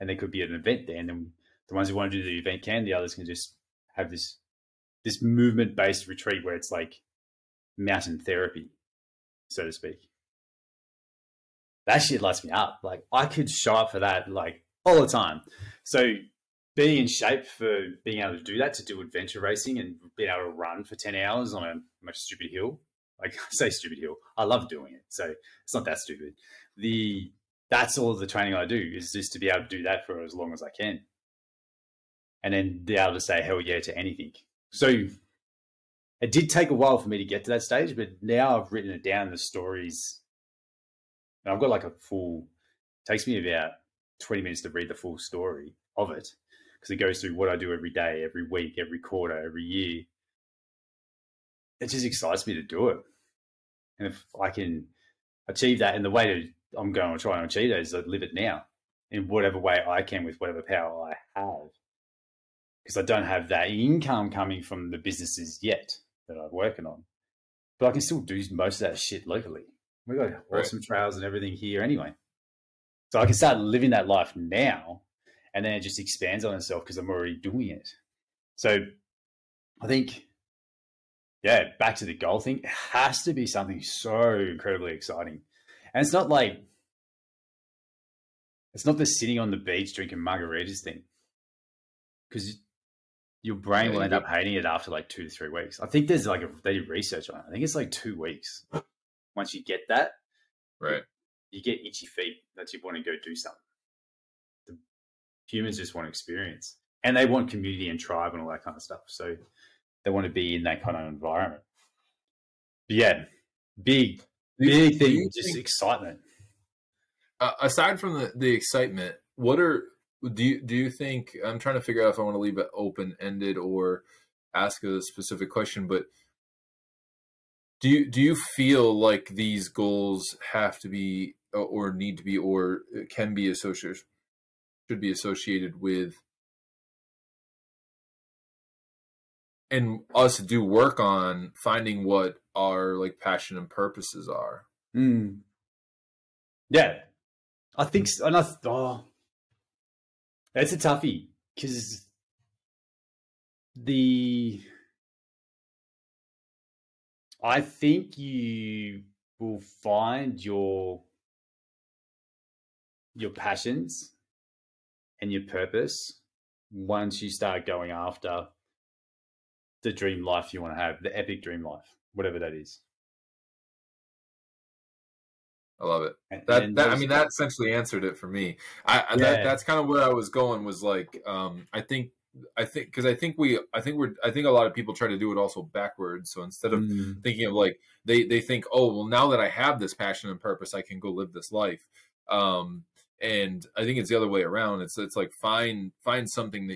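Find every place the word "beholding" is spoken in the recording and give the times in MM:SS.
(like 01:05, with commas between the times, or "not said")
not said.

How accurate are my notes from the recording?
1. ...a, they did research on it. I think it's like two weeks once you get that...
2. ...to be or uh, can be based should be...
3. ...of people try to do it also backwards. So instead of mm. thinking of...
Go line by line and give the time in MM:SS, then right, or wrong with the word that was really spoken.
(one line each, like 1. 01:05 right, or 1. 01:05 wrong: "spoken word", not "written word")
1. 01:36 right
2. 02:12 wrong: "associated", not "based"
3. 03:04 right.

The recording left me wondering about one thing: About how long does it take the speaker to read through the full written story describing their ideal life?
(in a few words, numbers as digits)
20 minutes.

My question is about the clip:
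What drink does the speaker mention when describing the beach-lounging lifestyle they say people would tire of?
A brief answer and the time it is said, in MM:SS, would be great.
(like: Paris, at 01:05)
margaritas, at 01:30.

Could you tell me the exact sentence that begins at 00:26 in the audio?
The that's all the training I do is just to be able to do that for as long as I can.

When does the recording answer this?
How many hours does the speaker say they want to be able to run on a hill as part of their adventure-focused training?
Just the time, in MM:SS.
00:20.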